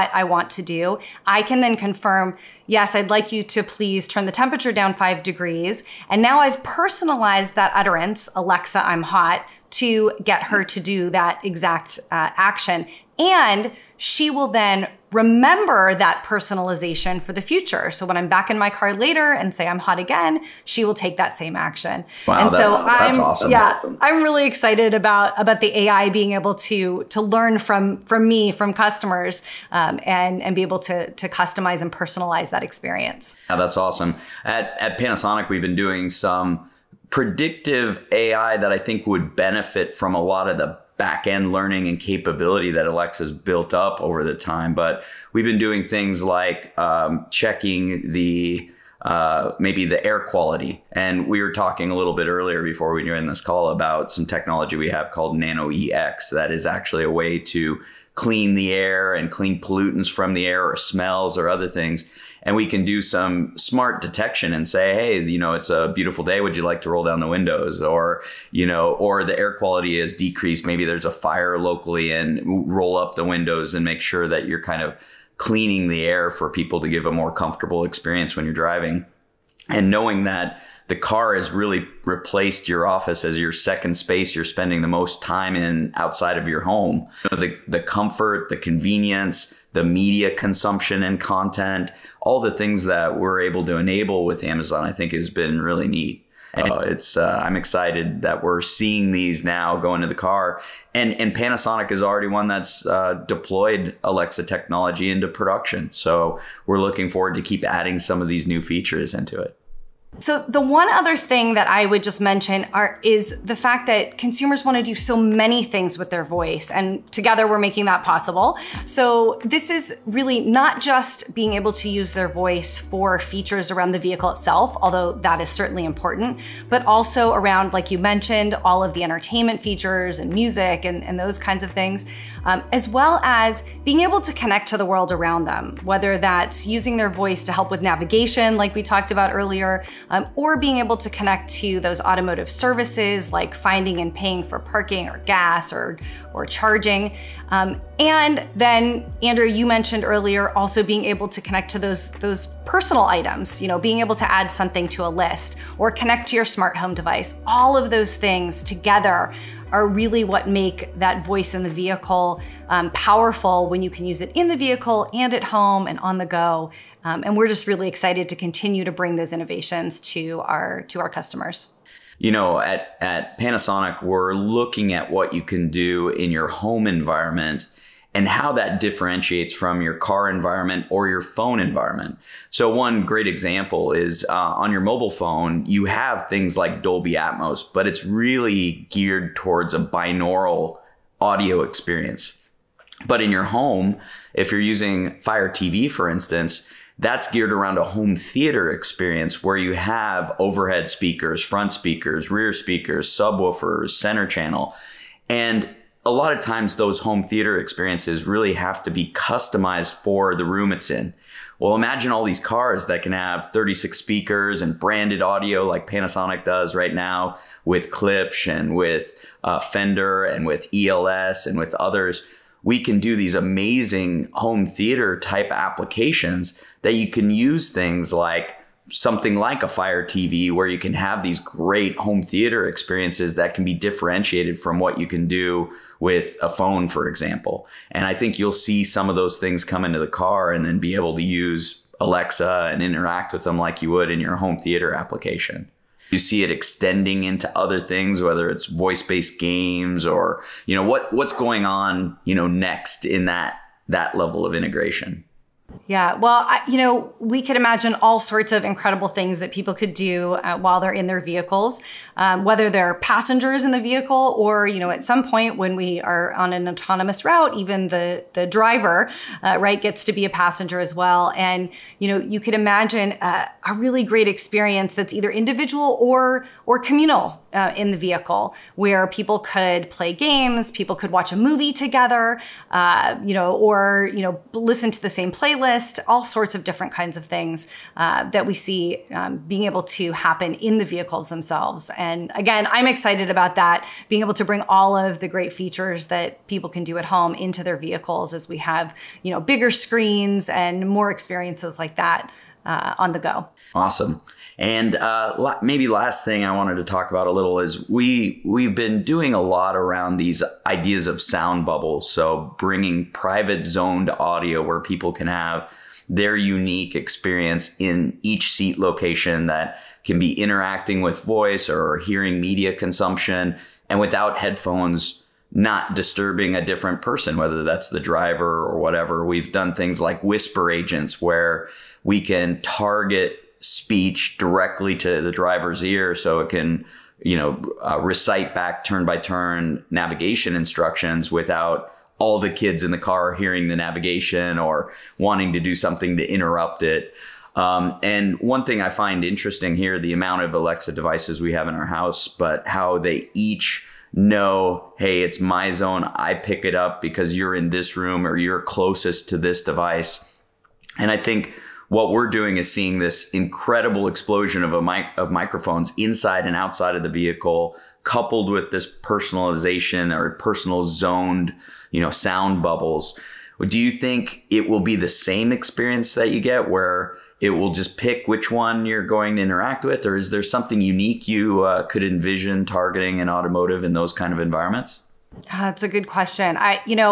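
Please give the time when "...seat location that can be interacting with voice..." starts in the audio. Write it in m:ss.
5:18.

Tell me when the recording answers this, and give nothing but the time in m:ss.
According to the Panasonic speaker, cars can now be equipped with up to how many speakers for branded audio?
3:33.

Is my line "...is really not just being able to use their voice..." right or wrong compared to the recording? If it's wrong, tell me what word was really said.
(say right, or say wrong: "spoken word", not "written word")
right.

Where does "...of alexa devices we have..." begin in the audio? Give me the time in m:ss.
5:50.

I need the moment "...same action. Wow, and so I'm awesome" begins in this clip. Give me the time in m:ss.
0:21.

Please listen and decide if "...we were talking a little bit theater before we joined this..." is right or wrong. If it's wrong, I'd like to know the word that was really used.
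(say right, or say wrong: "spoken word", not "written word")
wrong: "earlier", not "theater".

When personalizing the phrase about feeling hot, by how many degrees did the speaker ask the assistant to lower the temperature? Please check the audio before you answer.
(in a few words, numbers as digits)
5.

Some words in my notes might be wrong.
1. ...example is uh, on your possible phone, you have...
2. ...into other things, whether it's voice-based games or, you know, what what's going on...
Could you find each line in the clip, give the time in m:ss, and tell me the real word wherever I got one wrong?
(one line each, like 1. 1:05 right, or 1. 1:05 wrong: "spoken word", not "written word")
1. 3:03 wrong: "mobile", not "possible"
2. 4:07 right.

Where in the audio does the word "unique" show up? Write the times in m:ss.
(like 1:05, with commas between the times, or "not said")
5:16, 6:20.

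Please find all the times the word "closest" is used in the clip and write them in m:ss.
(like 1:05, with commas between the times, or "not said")
5:58.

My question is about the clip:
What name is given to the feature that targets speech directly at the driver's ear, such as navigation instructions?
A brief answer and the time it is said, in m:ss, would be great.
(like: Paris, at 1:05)
whisper agents, at 5:30.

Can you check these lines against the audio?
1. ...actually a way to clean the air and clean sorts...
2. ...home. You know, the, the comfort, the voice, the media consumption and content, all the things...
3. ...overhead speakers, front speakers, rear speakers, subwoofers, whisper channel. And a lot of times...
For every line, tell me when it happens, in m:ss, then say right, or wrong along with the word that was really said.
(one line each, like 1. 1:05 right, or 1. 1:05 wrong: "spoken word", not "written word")
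1. 0:56 wrong: "pollutants", not "sorts"
2. 1:26 wrong: "convenience", not "voice"
3. 3:20 wrong: "center", not "whisper".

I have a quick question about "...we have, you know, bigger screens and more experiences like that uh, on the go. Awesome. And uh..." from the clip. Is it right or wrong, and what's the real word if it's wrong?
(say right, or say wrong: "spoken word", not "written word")
right.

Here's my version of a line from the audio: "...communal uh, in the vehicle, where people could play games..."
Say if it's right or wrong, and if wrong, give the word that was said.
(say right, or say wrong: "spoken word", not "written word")
right.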